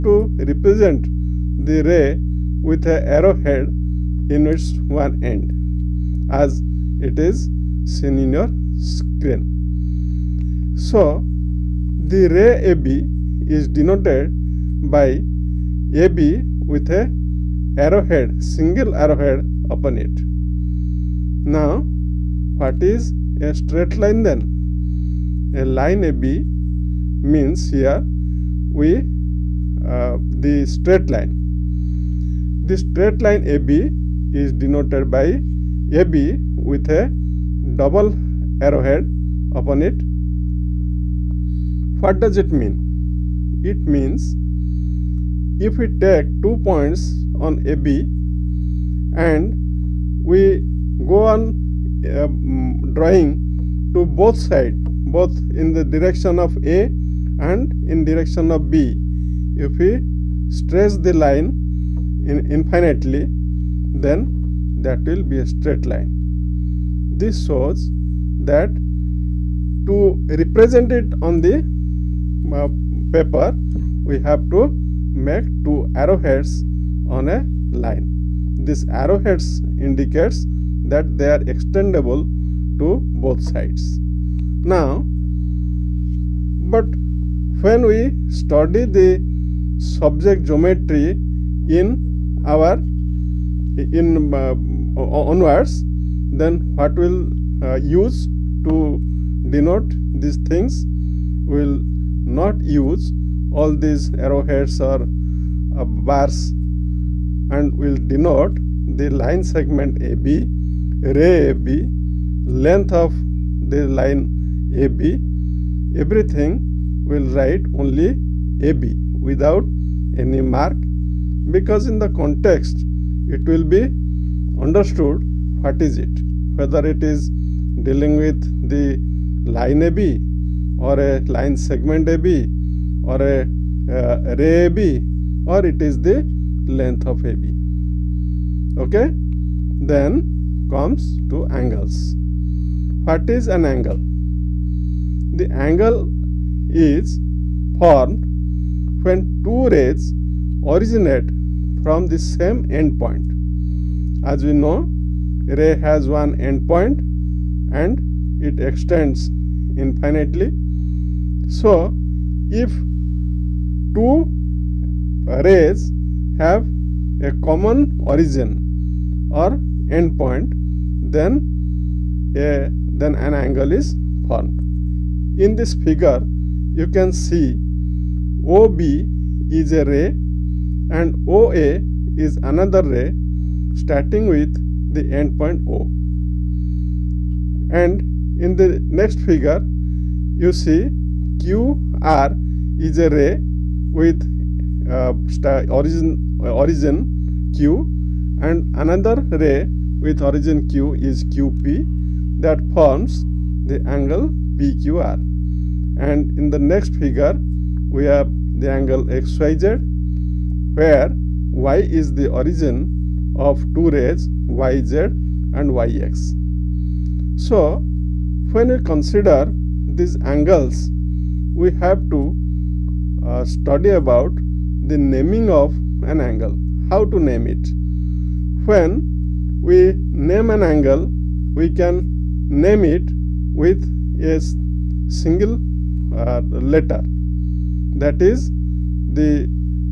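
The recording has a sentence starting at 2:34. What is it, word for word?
As we know, ray has one endpoint and it extends infinitely.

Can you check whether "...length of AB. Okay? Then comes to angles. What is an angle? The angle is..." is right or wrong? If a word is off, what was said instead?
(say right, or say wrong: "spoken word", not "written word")
right.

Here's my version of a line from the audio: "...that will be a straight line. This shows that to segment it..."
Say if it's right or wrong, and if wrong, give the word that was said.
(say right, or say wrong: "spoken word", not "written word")
wrong: "represent", not "segment".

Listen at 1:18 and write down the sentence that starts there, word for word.
This arrowheads indicates that they are extendable to both sides.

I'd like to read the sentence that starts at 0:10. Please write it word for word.
So, the ray AB is denoted by AB with a arrowhead, single arrowhead upon it.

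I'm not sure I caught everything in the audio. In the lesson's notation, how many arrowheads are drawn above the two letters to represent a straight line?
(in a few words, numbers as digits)
2 (double arrowhead).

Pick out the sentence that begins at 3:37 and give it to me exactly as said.
So, when we consider these angles, we have to uh, study about the naming of an angle, how to name it.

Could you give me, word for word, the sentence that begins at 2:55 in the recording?
In this figure you can see OB is a ray and OA is another ray starting with the endpoint O.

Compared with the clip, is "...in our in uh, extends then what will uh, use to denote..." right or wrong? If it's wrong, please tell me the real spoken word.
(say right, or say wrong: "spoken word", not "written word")
wrong: "onwards", not "extends".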